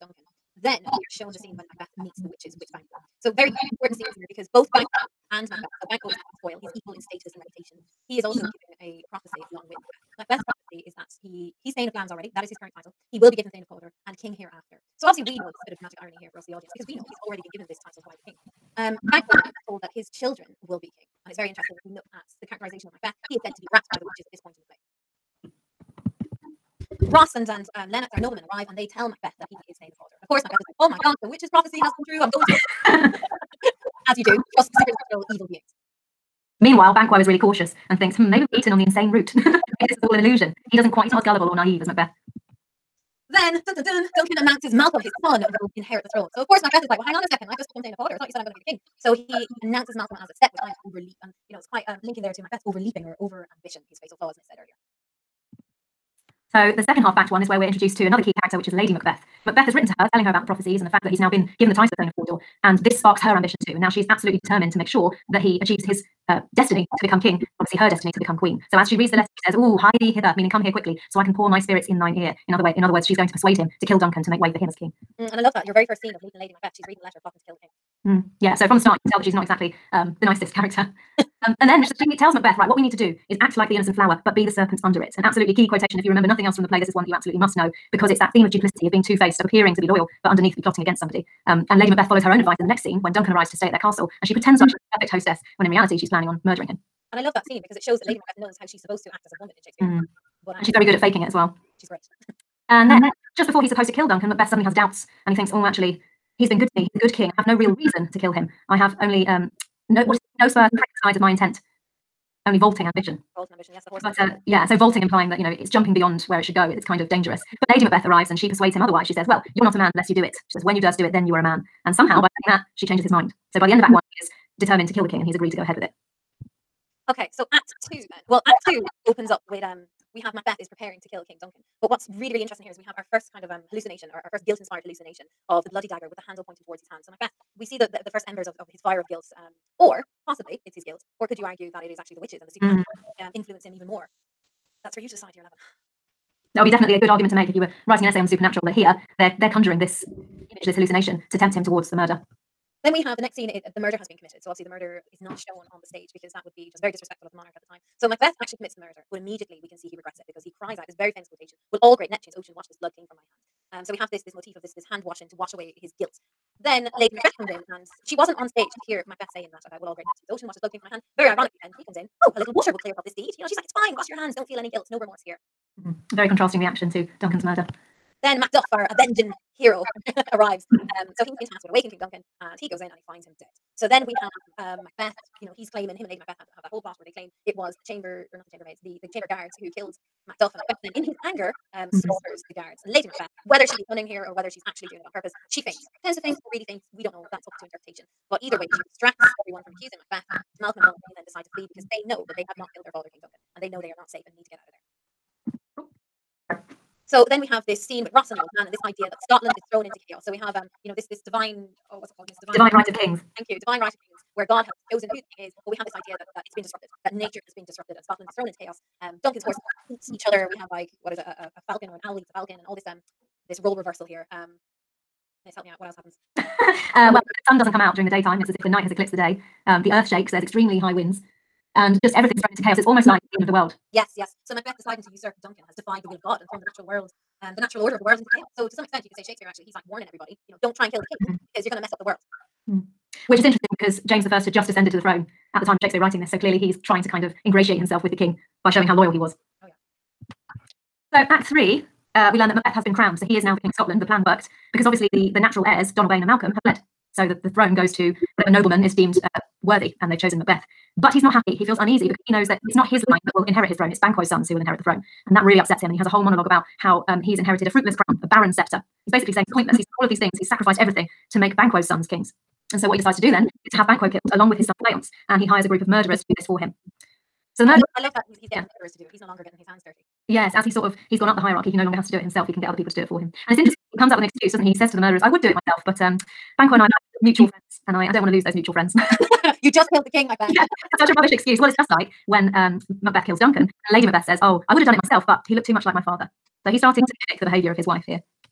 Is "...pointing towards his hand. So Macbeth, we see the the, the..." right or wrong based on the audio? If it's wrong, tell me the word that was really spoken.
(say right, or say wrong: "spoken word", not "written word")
right.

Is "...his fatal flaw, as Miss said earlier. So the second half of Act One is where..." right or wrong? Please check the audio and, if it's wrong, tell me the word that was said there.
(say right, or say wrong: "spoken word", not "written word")
right.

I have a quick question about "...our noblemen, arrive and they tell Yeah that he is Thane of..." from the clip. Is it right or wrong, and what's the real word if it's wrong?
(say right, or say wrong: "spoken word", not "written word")
wrong: "Macbeth", not "Yeah".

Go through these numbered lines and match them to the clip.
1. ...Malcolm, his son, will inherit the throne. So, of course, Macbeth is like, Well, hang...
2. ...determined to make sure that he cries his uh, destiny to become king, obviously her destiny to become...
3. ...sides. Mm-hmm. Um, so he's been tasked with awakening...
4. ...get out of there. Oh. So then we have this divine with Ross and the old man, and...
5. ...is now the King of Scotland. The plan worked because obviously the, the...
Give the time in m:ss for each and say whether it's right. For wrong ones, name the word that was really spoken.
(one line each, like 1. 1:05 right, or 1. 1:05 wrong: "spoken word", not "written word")
1. 0:44 right
2. 1:04 wrong: "achieves", not "cries"
3. 3:00 wrong: "arrives", not "sides"
4. 3:24 wrong: "scene", not "divine"
5. 4:13 right.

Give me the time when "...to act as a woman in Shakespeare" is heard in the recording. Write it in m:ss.
1:39.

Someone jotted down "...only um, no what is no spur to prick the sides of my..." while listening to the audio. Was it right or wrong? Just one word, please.
right.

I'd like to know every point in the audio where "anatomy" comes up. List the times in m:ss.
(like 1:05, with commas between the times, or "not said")
not said.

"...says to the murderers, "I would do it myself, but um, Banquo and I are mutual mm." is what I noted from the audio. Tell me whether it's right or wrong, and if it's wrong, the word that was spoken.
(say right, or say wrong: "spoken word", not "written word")
right.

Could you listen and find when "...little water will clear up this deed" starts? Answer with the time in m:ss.
2:52.